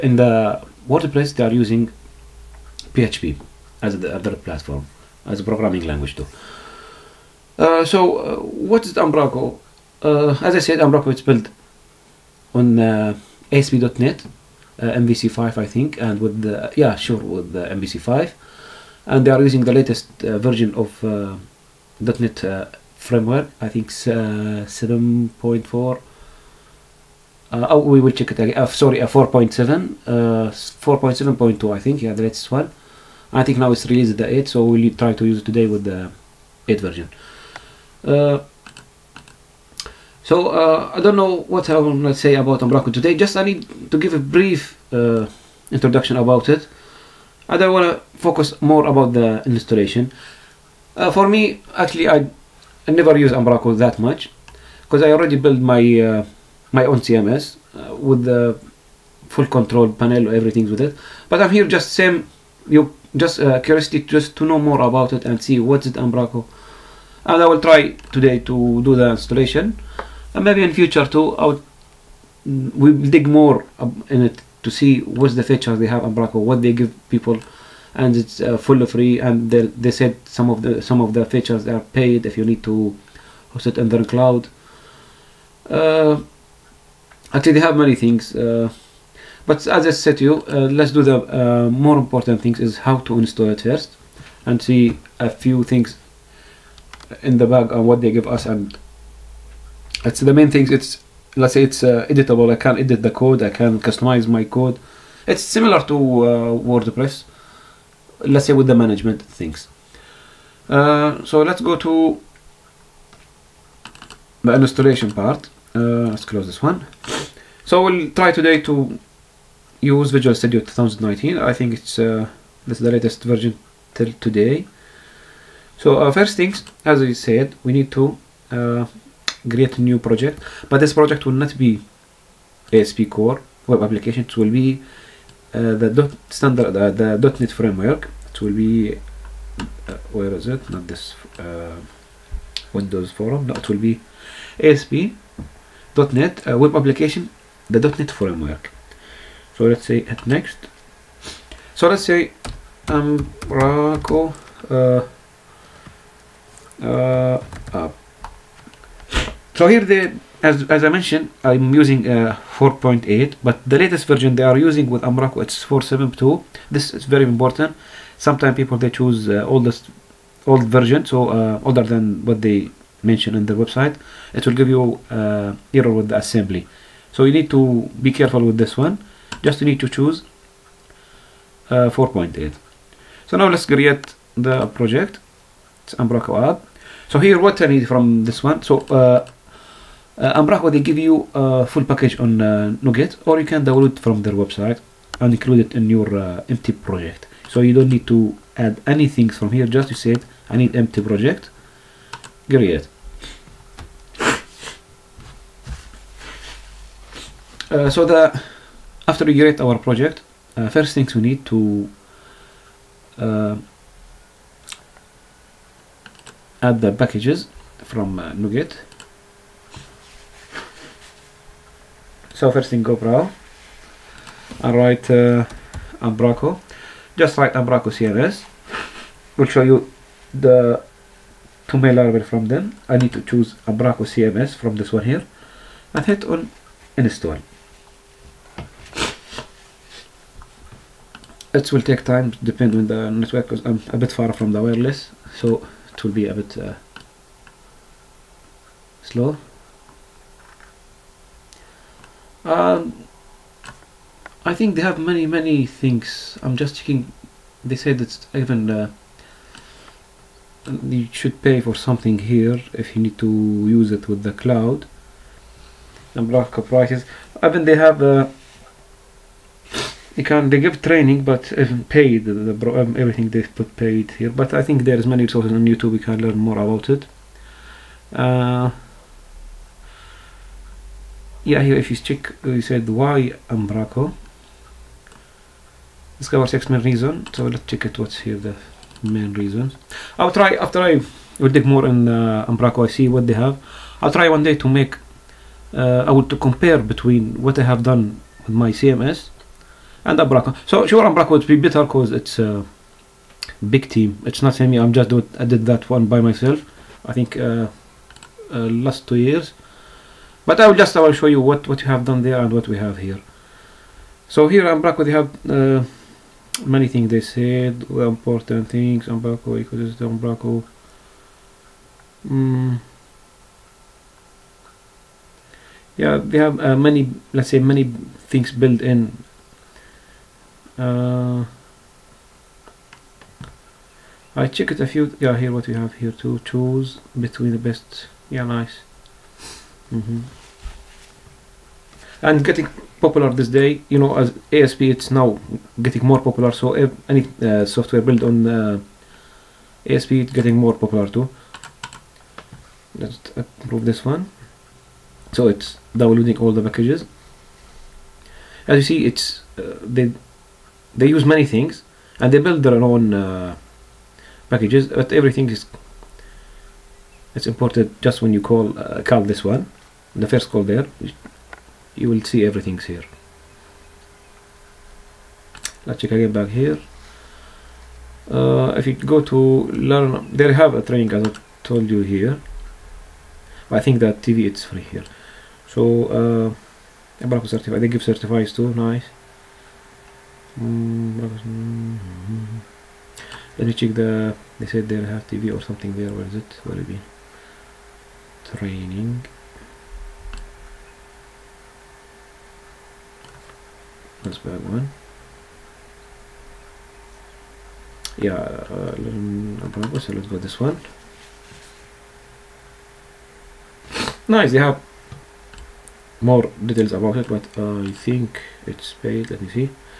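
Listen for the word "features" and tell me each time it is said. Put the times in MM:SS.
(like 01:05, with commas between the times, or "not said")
01:15, 01:21.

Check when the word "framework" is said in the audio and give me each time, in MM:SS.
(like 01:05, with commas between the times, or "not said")
00:22, 02:17, 02:28.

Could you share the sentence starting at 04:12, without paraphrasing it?
Um, I think they have many, many things.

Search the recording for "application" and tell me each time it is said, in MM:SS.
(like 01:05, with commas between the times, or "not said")
02:13, 02:26.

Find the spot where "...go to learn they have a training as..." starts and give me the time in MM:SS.
06:18.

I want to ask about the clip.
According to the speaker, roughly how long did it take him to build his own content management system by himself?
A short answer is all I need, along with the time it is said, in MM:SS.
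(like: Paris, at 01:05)
two years, at 05:08.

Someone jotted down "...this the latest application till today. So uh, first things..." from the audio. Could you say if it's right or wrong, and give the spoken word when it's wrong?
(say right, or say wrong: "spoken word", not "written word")
wrong: "version", not "application".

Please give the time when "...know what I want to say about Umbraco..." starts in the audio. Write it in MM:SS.
00:41.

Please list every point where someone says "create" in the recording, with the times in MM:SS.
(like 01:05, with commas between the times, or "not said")
02:09, 03:03, 03:29.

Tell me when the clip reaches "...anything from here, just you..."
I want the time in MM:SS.
03:18.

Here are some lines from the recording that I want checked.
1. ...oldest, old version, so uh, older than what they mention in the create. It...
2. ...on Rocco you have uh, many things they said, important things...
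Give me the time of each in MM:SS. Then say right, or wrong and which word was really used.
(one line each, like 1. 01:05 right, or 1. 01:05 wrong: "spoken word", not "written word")
1. 02:49 wrong: "website", not "create"
2. 05:14 wrong: "Blackwood", not "Rocco".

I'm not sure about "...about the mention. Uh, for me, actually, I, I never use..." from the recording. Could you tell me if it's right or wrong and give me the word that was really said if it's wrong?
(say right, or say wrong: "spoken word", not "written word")
wrong: "installation", not "mention".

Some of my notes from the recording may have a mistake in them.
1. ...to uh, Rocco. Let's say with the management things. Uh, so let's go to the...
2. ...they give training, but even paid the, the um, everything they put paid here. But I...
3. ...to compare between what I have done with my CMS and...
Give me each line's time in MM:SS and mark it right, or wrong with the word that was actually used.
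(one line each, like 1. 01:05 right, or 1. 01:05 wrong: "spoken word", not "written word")
1. 01:45 wrong: "WordPress", not "Rocco"
2. 04:30 right
3. 04:56 right.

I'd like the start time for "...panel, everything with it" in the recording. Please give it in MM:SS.
00:59.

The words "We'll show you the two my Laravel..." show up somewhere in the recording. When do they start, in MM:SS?
03:49.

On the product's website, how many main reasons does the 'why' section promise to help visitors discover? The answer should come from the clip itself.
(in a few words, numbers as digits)
6.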